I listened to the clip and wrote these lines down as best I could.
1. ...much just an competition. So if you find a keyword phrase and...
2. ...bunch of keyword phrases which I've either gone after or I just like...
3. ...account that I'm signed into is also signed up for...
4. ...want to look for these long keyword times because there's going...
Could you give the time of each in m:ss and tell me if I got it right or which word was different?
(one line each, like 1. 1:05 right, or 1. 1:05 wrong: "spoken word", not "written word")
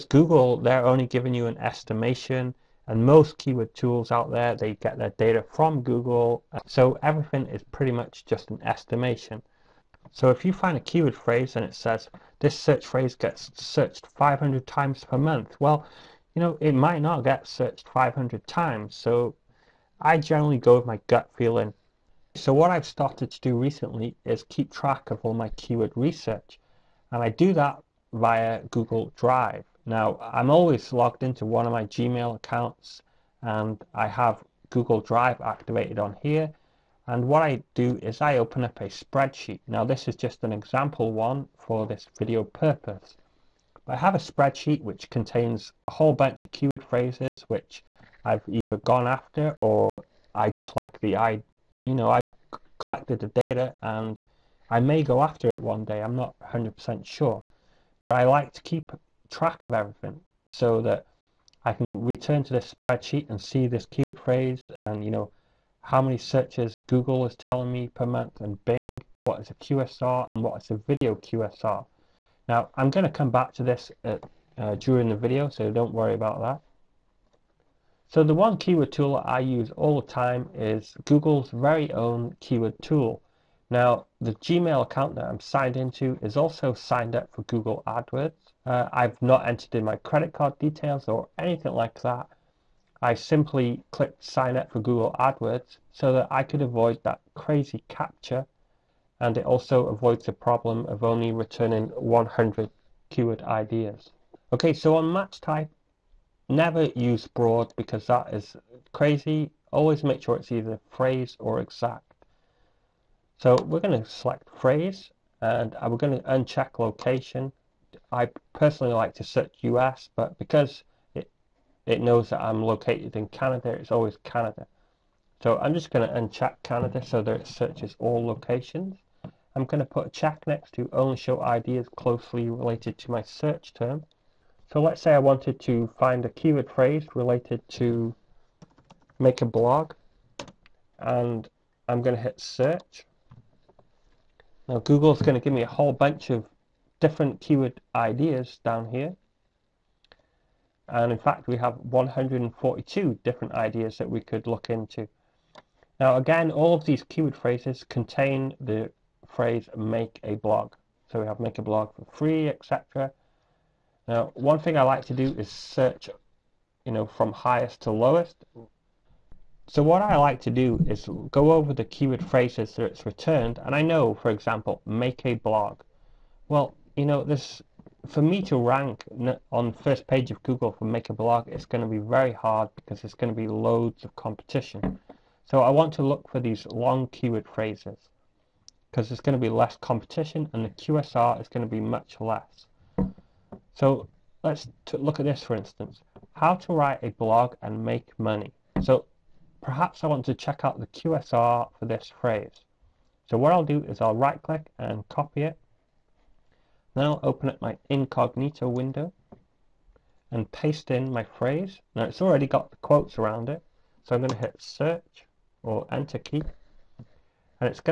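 1. 0:07 wrong: "estimation", not "competition"
2. 0:46 right
3. 1:24 right
4. 3:05 wrong: "phrases", not "times".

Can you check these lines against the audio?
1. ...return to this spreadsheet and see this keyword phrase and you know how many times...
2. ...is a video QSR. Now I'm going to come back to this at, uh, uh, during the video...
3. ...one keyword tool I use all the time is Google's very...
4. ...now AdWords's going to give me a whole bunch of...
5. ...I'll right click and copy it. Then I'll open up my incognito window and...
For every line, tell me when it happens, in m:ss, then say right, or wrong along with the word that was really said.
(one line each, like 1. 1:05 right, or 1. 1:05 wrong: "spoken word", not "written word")
1. 1:02 wrong: "searches", not "times"
2. 1:10 right
3. 1:18 right
4. 2:24 wrong: "Google", not "AdWords"
5. 3:24 right.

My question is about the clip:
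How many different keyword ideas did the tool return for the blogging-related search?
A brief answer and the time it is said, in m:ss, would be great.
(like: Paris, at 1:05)
142, at 2:31.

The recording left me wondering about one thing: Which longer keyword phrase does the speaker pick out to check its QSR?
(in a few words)
How to write a blog and make money.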